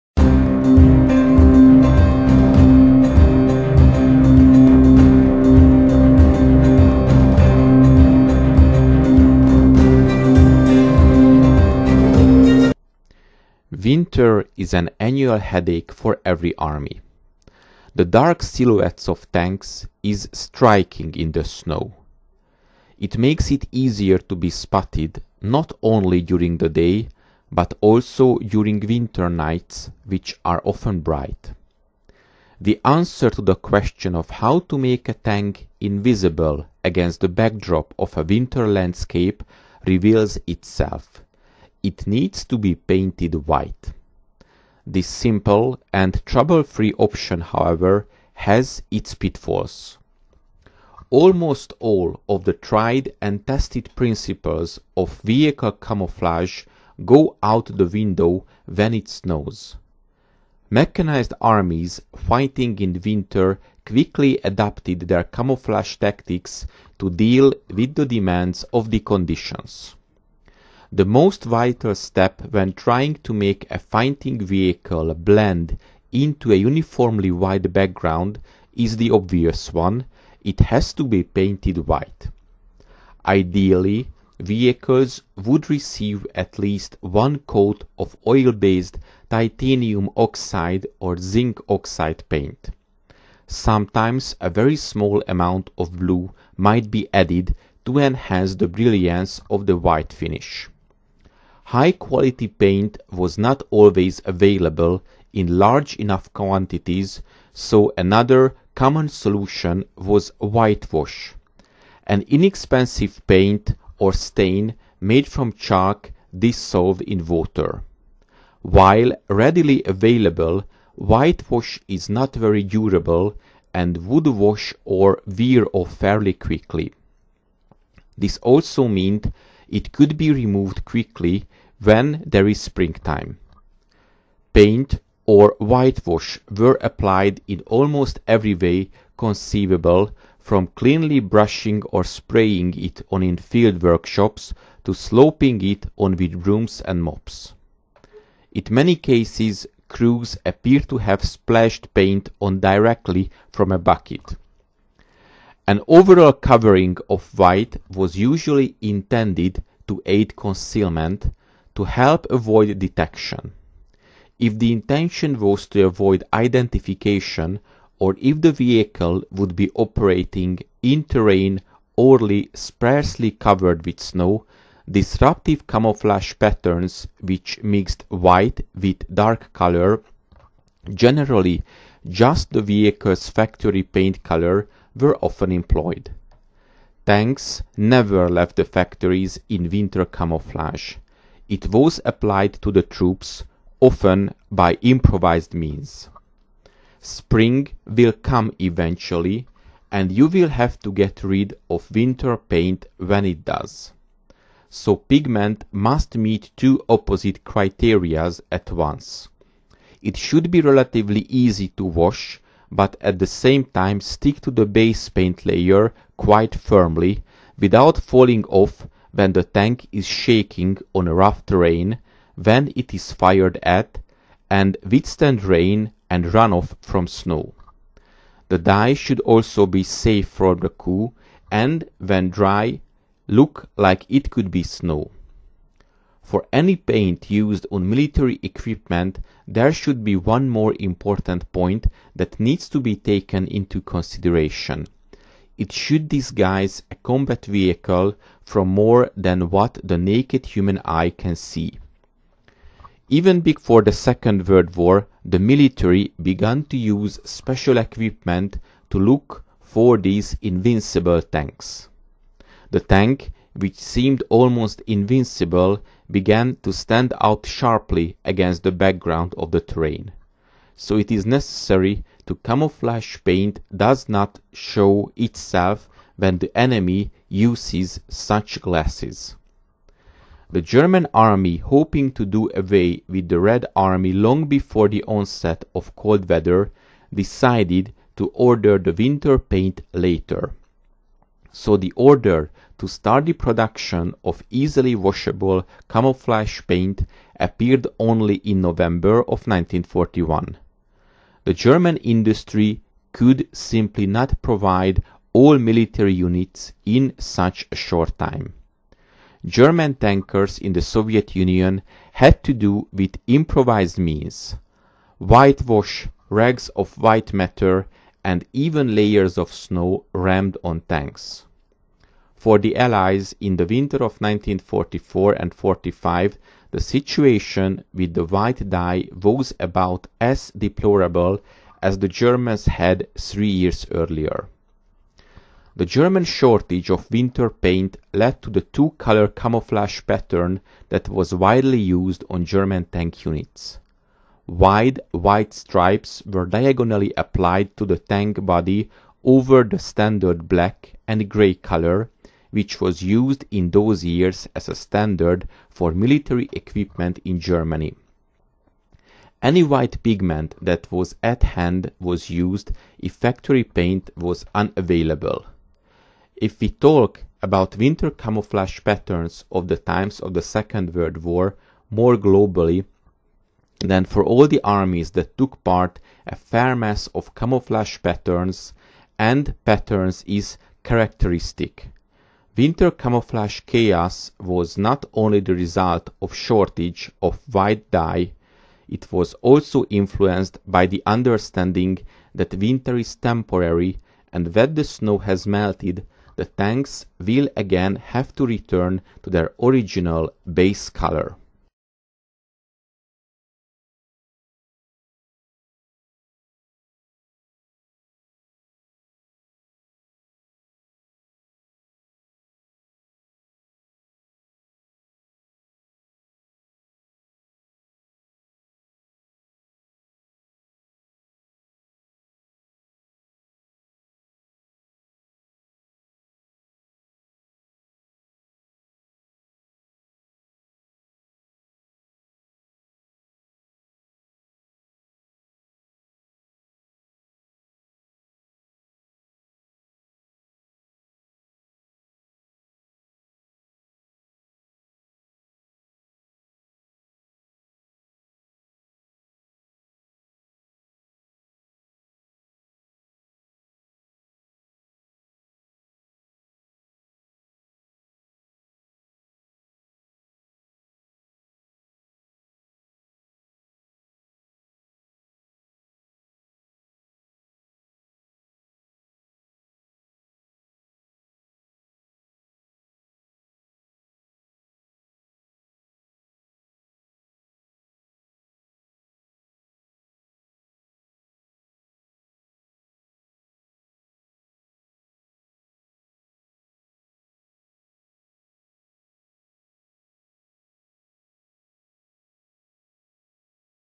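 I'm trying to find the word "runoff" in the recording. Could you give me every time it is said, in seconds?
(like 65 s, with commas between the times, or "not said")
226 s.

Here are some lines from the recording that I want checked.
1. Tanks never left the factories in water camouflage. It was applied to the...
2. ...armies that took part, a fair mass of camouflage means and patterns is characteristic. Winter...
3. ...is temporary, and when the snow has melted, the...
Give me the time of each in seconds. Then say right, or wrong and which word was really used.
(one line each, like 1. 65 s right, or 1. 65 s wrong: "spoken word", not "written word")
1. 187 s wrong: "winter", not "water"
2. 374 s wrong: "patterns", not "means"
3. 392 s right.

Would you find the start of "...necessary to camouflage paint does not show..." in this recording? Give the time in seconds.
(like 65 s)
271 s.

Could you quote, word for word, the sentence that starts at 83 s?
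Ideally, vehicles would receive at least one coat of oil-based titanium oxide or zinc oxide paint.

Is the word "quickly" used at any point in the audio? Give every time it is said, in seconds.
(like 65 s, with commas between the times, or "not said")
63 s, 126 s, 130 s.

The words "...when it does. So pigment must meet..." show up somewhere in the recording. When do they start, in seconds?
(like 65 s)
202 s.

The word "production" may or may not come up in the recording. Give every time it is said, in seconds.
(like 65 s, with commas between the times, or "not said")
293 s.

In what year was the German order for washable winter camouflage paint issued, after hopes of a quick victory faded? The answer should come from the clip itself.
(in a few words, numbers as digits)
1941.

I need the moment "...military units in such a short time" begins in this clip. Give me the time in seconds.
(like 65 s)
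305 s.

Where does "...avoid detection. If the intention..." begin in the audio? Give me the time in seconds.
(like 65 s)
162 s.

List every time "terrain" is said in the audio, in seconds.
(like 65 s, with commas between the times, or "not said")
171 s, 221 s, 269 s.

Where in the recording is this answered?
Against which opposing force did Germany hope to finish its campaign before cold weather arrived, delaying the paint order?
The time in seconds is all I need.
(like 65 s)
283 s.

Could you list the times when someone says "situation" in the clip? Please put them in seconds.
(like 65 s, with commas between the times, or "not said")
326 s.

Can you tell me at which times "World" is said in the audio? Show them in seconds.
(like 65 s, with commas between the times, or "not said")
254 s, 370 s.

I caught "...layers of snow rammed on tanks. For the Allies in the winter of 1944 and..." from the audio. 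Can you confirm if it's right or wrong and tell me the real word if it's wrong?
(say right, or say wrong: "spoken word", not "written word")
right.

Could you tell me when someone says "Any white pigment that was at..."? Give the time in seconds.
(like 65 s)
359 s.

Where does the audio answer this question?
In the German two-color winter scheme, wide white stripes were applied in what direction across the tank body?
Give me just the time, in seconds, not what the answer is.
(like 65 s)
346 s.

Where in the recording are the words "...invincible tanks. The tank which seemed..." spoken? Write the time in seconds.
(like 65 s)
260 s.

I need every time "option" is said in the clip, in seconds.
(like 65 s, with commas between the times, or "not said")
46 s.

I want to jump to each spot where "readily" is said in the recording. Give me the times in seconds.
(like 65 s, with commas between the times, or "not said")
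119 s.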